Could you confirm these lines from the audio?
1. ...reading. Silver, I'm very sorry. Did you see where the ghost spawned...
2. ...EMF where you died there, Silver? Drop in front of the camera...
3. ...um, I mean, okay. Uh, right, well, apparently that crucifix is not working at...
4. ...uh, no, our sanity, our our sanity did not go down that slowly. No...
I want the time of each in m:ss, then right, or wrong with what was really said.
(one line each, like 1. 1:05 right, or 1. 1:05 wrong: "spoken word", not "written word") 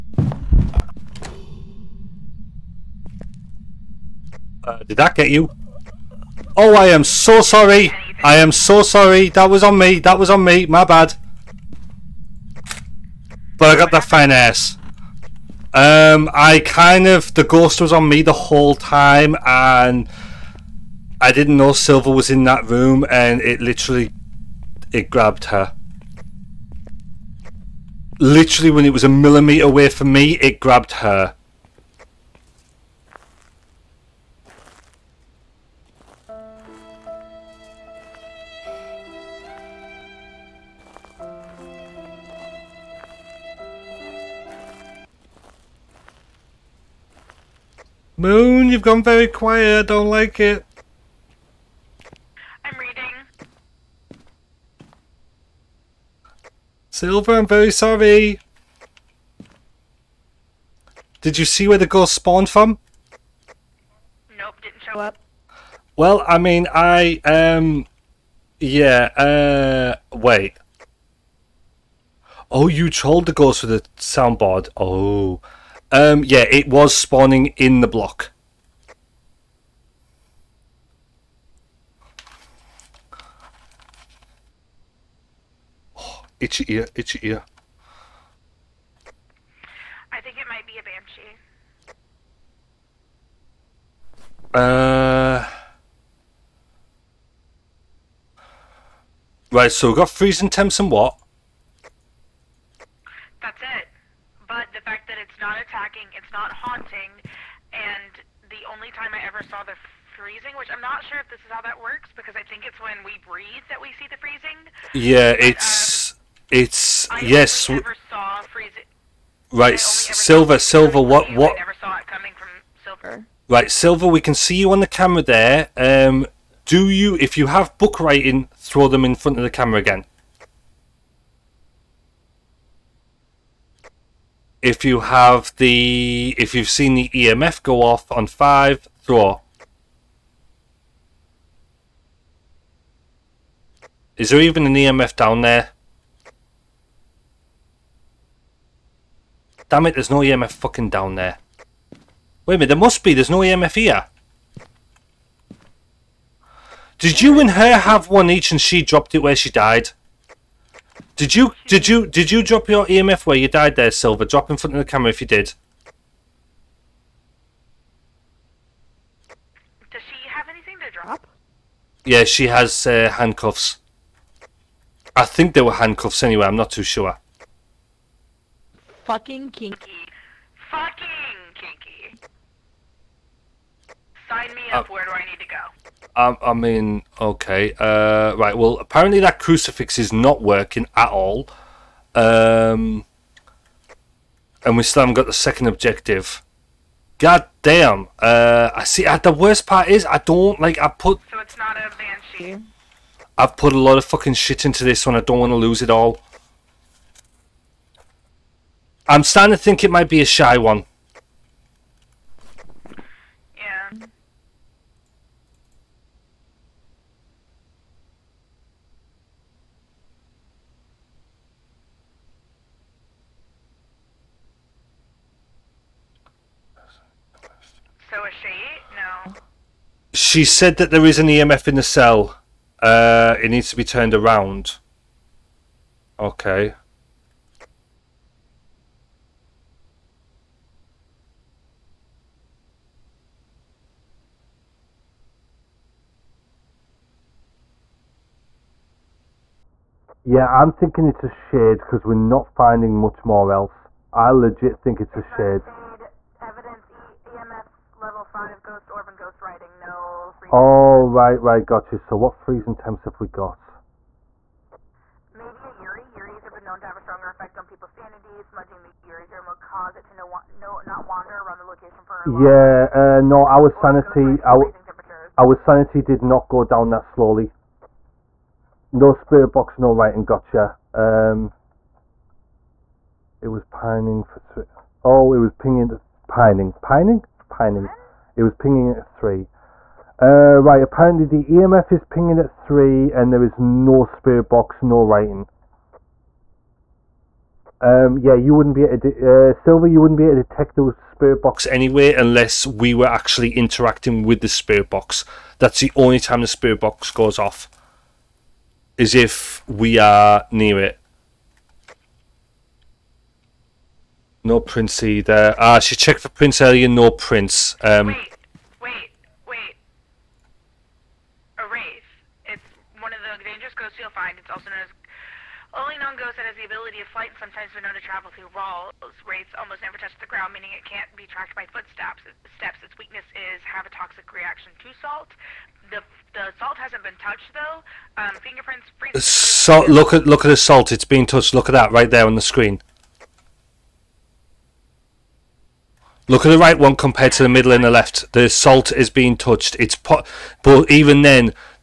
1. 0:52 right
2. 2:42 right
3. 3:06 right
4. 4:32 right.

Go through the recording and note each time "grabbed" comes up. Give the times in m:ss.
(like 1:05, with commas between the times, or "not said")
0:25, 0:30.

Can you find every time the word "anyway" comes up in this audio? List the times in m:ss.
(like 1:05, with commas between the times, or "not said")
2:56, 5:01.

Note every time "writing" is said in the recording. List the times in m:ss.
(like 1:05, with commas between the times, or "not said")
2:07, 4:19, 4:39, 4:55.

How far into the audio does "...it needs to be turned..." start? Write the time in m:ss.
3:53.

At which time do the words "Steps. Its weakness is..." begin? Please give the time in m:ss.
5:32.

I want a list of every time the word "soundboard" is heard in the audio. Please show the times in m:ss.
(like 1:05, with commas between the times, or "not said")
1:14.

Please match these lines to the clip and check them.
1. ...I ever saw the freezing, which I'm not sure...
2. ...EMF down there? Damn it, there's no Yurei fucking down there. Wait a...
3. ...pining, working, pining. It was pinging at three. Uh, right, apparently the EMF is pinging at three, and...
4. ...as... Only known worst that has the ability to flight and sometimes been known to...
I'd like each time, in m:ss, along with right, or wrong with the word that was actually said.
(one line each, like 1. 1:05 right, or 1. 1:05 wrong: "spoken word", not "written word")
1. 1:49 right
2. 2:24 wrong: "EMF", not "Yurei"
3. 4:46 wrong: "pining", not "working"
4. 5:24 wrong: "ghost", not "worst".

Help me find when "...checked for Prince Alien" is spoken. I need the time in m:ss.
5:15.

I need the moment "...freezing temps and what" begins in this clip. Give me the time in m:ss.
1:40.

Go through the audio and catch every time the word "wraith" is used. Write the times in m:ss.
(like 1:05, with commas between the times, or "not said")
5:21, 5:29.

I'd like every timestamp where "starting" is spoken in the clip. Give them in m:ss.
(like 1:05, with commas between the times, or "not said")
3:29.